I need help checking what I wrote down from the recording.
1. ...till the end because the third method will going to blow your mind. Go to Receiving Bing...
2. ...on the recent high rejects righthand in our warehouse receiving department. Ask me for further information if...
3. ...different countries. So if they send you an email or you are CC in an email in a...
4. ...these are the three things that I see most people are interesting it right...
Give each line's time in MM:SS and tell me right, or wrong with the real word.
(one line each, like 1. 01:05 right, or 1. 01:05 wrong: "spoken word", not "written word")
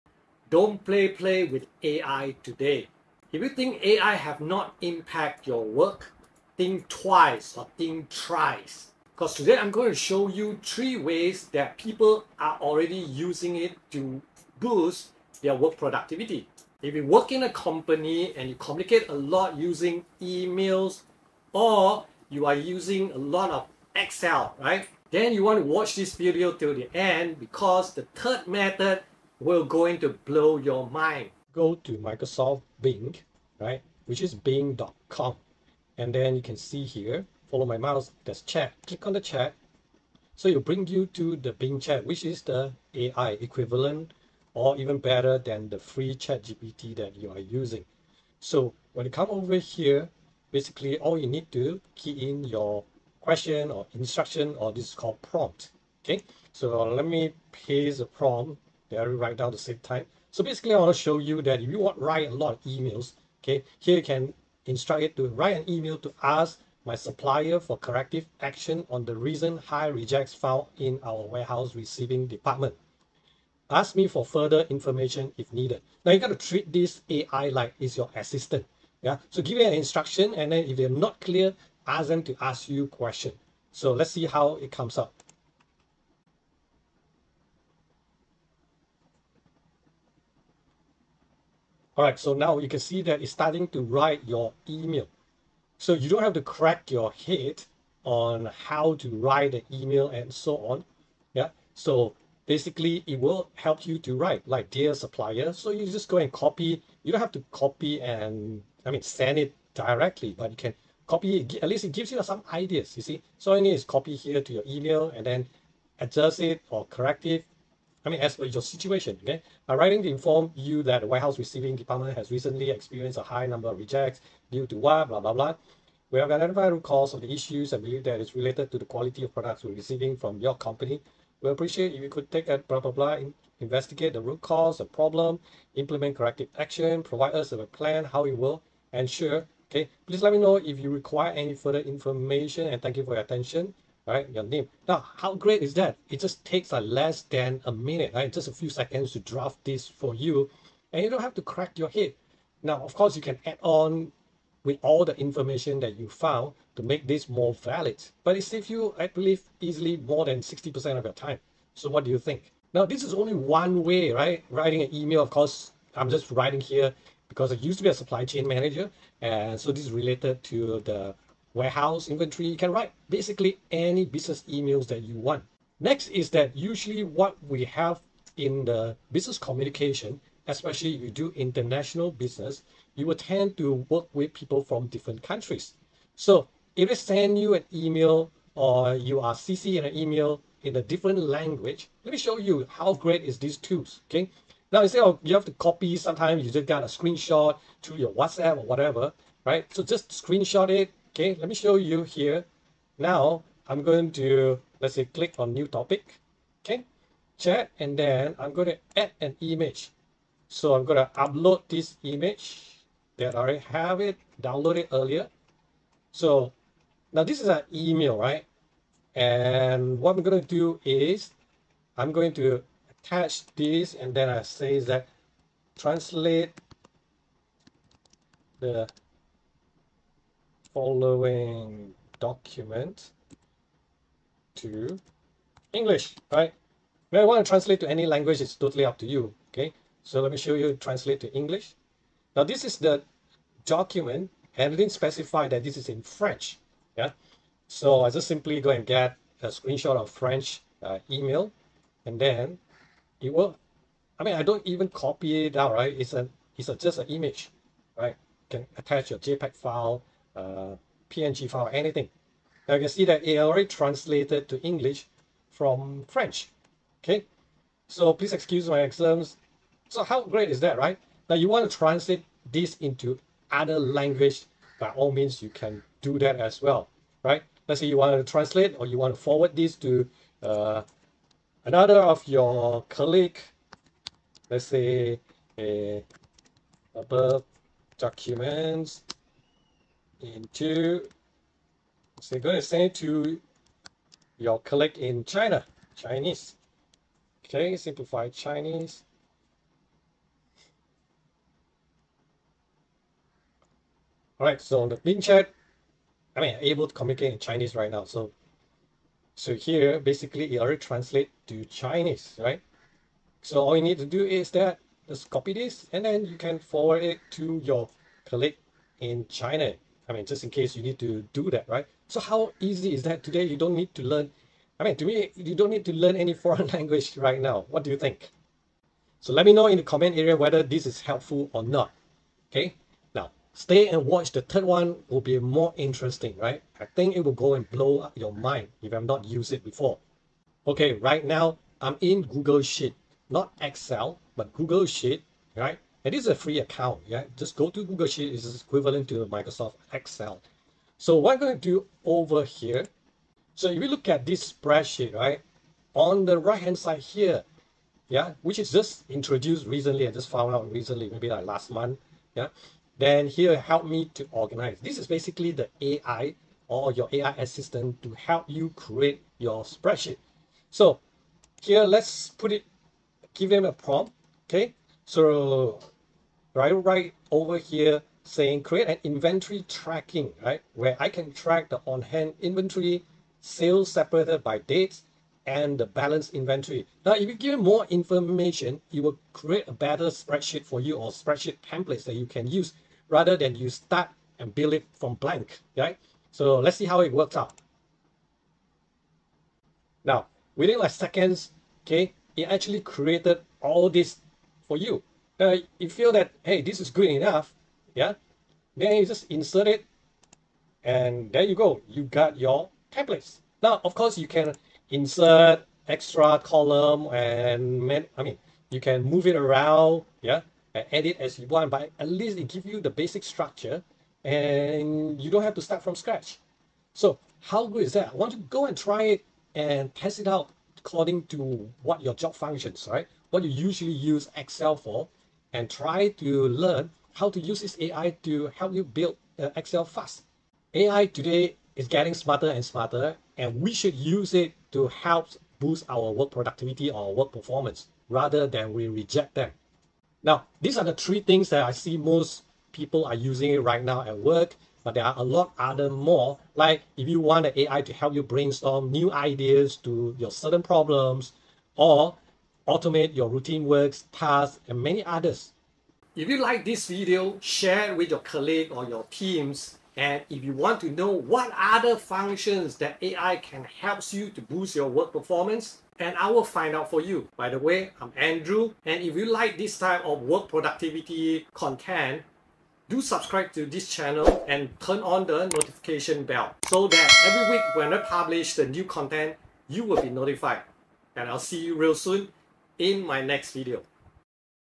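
1. 00:26 wrong: "Microsoft", not "Receiving"
2. 01:08 wrong: "found", not "righthand"
3. 03:04 right
4. 07:30 wrong: "using", not "interesting".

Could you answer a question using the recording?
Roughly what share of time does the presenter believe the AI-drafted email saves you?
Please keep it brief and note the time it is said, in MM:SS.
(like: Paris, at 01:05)
more than 60%, at 02:39.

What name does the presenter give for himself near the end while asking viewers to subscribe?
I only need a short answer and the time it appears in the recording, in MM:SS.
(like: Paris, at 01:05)
Andrew, at 07:58.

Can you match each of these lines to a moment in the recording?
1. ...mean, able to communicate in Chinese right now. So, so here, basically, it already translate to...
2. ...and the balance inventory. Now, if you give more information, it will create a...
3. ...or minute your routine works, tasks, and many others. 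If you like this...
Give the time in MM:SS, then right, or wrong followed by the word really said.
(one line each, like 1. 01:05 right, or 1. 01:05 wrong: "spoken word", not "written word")
1. 05:06 right
2. 06:25 right
3. 07:41 wrong: "automate", not "minute".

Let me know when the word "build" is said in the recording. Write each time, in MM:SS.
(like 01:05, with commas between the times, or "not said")
06:34, 07:18.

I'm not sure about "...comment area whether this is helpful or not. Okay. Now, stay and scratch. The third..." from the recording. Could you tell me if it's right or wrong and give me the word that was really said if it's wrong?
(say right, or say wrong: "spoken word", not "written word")
wrong: "watch", not "scratch".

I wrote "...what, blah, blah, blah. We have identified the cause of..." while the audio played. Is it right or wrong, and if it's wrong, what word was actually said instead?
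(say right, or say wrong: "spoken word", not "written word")
right.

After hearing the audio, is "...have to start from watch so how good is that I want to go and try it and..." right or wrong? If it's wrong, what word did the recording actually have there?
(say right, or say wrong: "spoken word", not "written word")
wrong: "scratch", not "watch".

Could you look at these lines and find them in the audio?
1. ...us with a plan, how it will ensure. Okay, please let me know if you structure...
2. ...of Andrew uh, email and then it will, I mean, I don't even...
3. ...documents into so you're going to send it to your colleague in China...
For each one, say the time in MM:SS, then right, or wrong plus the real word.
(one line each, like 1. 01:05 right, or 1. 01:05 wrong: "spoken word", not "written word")
1. 02:17 wrong: "require", not "structure"
2. 04:09 wrong: "French", not "Andrew"
3. 04:47 right.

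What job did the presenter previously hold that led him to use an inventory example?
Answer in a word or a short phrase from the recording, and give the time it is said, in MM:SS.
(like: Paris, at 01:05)
supply chain manager, at 02:47.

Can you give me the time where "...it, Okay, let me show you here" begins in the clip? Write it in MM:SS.
03:20.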